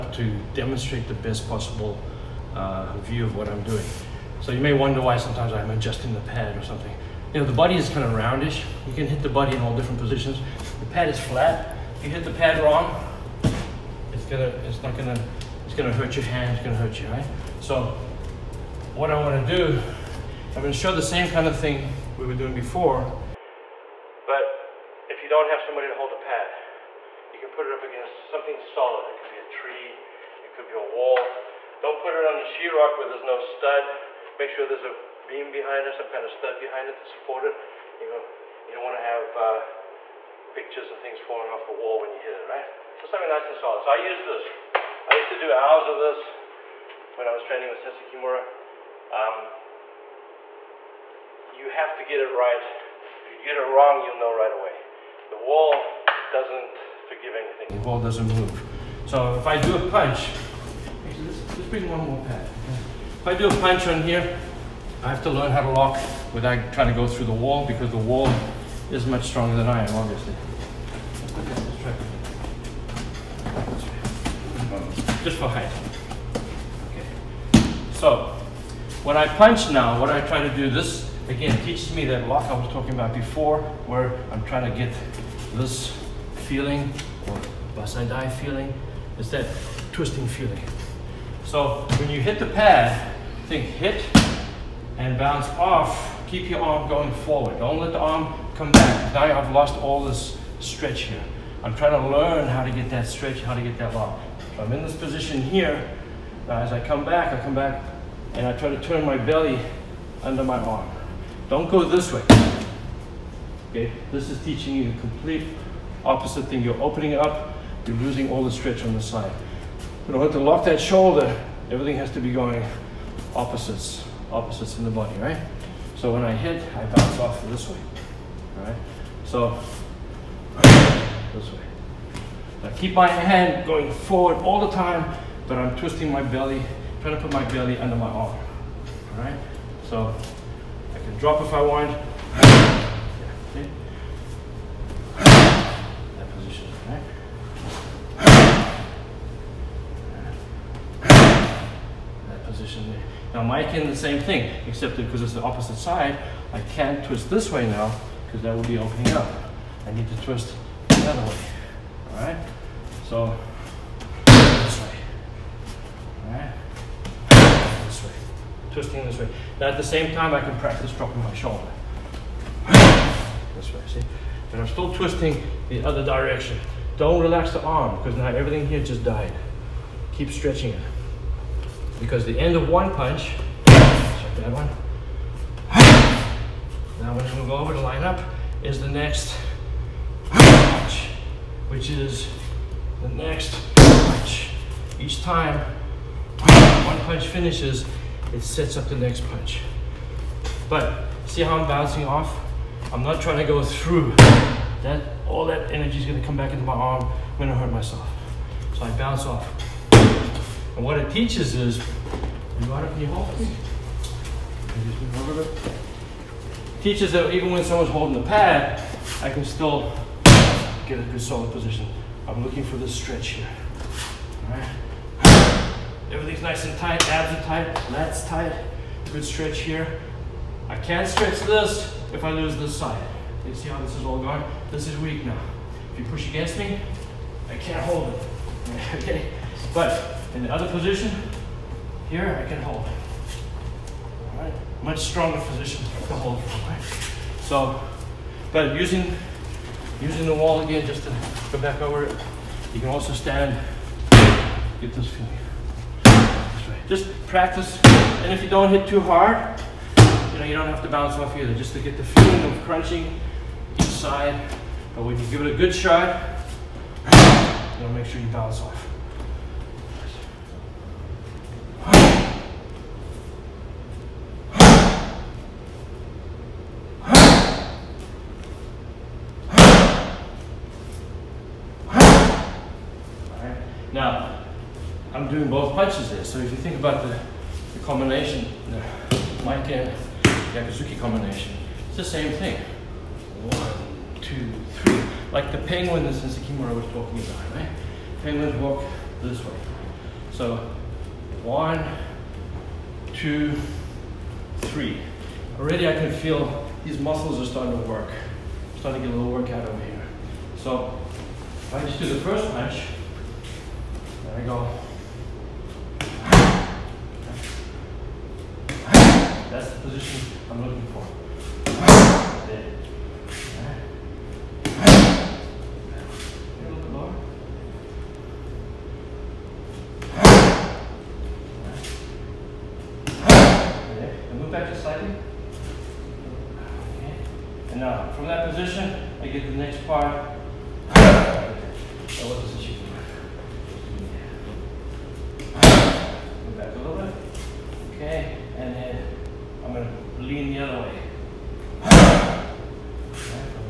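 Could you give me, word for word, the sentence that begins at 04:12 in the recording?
You can also stand, get this feeling.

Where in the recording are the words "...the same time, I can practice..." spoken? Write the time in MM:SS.
02:49.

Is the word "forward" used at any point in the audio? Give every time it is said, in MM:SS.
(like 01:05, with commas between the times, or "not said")
01:37, 02:13.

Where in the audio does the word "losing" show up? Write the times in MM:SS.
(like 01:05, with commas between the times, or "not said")
01:57.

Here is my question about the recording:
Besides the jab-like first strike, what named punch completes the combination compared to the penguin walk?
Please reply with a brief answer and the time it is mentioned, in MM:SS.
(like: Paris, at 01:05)
gyakuzuki, at 04:50.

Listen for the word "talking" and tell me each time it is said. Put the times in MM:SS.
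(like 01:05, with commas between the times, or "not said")
01:22, 04:56.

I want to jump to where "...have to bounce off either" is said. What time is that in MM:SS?
04:20.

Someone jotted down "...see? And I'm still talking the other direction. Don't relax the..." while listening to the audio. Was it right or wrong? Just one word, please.
wrong.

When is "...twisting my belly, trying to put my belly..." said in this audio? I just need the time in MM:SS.
02:15.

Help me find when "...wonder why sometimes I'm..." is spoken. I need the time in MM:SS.
00:04.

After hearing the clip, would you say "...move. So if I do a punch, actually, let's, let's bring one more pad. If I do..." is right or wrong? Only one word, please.
right.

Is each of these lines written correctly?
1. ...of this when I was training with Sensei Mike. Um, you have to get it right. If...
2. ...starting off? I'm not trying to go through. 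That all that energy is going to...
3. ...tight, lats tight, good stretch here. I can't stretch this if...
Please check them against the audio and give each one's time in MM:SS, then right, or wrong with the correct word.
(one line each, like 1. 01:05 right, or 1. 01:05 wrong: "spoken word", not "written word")
1. 00:45 wrong: "Kimura", not "Mike"
2. 03:21 wrong: "bouncing", not "starting"
3. 03:47 right.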